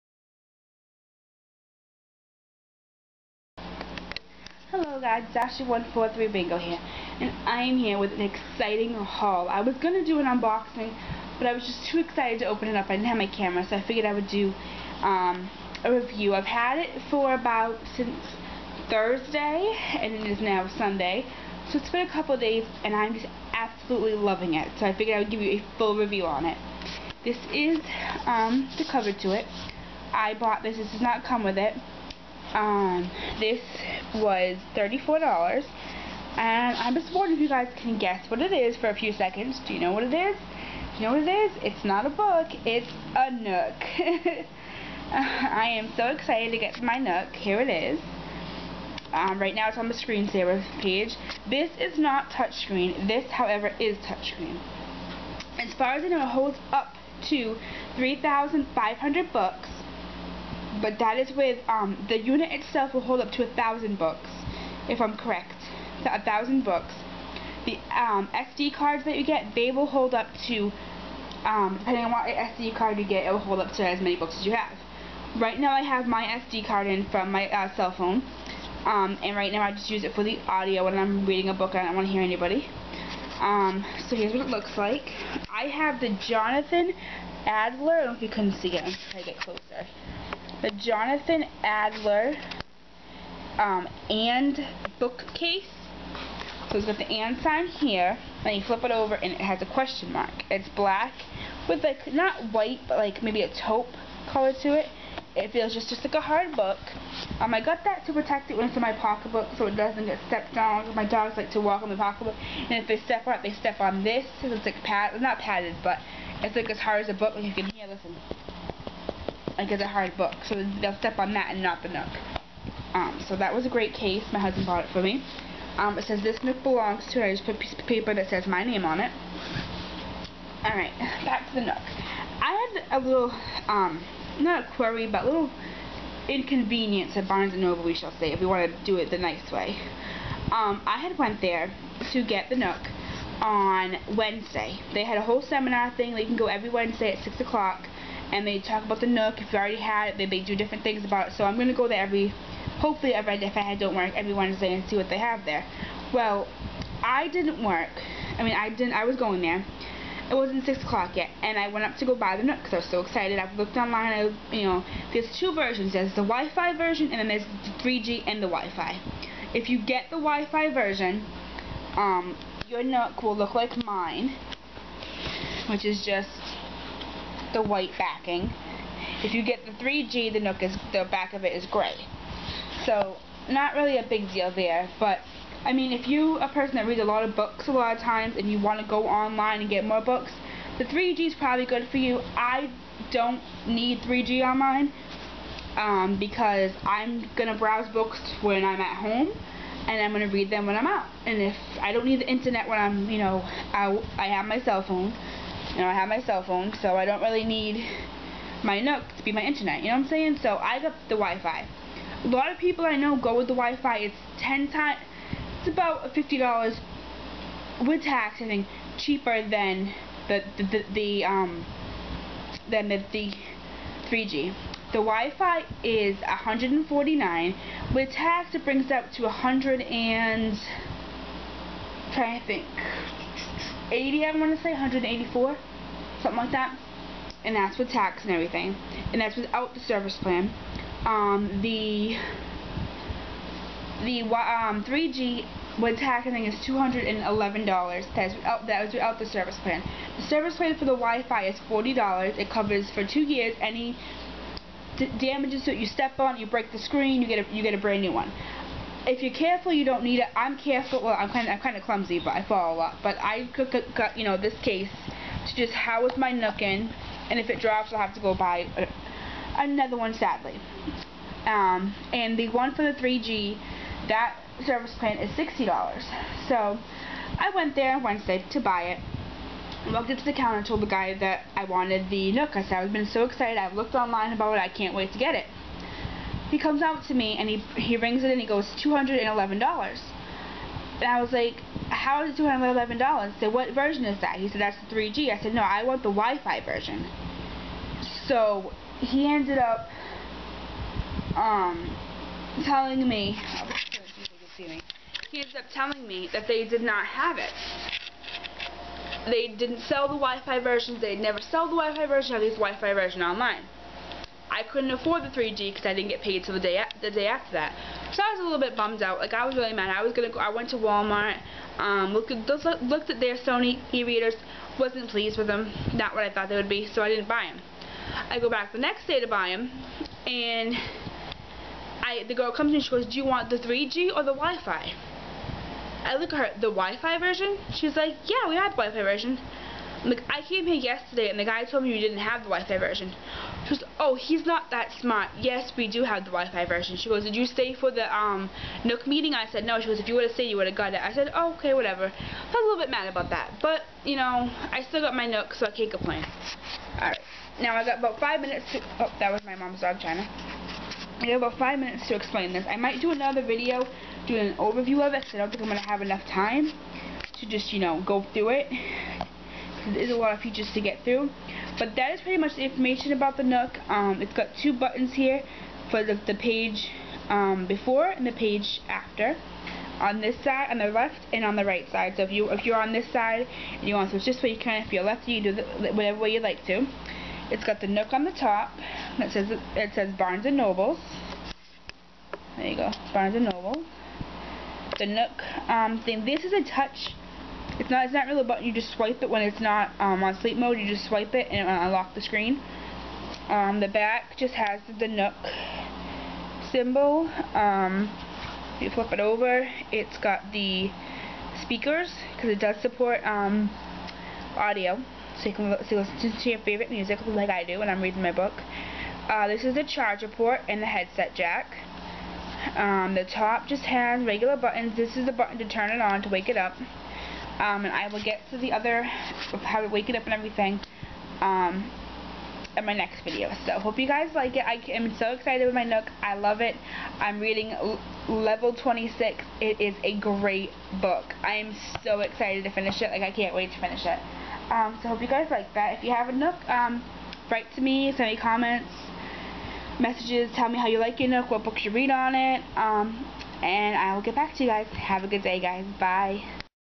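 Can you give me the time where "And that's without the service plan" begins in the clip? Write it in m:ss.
3:59.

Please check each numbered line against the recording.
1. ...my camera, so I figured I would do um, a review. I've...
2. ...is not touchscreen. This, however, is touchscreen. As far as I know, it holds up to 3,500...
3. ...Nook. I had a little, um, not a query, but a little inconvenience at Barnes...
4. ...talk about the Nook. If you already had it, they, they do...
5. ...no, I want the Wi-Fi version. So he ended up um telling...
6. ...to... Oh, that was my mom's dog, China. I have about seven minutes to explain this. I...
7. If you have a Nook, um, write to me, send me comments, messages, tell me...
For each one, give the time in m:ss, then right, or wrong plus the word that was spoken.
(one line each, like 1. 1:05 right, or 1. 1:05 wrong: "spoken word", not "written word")
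1. 0:13 right
2. 0:51 right
3. 2:11 right
4. 2:28 right
5. 4:55 right
6. 5:58 wrong: "five", not "seven"
7. 7:25 right.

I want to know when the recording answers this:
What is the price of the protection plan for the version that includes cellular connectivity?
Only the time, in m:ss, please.
4:35.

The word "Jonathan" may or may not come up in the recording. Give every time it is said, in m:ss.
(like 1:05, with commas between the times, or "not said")
1:26, 1:30.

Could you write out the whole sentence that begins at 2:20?
Um, I had went there to get the Nook on Wednesday.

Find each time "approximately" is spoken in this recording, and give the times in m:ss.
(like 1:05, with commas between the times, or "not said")
not said.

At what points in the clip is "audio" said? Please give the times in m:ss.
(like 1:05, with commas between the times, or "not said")
1:20, 6:54.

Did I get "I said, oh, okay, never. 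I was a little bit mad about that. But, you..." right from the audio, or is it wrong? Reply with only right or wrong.
wrong.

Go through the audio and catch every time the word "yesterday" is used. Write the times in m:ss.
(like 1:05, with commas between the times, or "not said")
5:40.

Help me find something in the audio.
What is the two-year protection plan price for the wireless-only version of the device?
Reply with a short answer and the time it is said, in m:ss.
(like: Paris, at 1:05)
$40, at 4:11.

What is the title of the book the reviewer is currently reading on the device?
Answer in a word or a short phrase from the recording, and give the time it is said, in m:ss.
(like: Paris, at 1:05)
Level 26, at 7:18.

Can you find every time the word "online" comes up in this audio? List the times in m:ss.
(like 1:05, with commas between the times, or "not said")
2:43, 3:09, 4:43, 5:13.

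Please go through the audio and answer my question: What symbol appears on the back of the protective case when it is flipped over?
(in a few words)
question mark.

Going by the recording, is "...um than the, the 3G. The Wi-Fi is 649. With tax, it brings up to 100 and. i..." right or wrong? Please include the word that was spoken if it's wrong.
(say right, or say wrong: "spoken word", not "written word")
wrong: "149", not "649".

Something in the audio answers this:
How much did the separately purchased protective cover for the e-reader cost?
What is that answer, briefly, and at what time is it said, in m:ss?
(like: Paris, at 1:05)
$34, at 0:34.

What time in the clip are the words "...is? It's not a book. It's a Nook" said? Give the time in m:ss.
0:41.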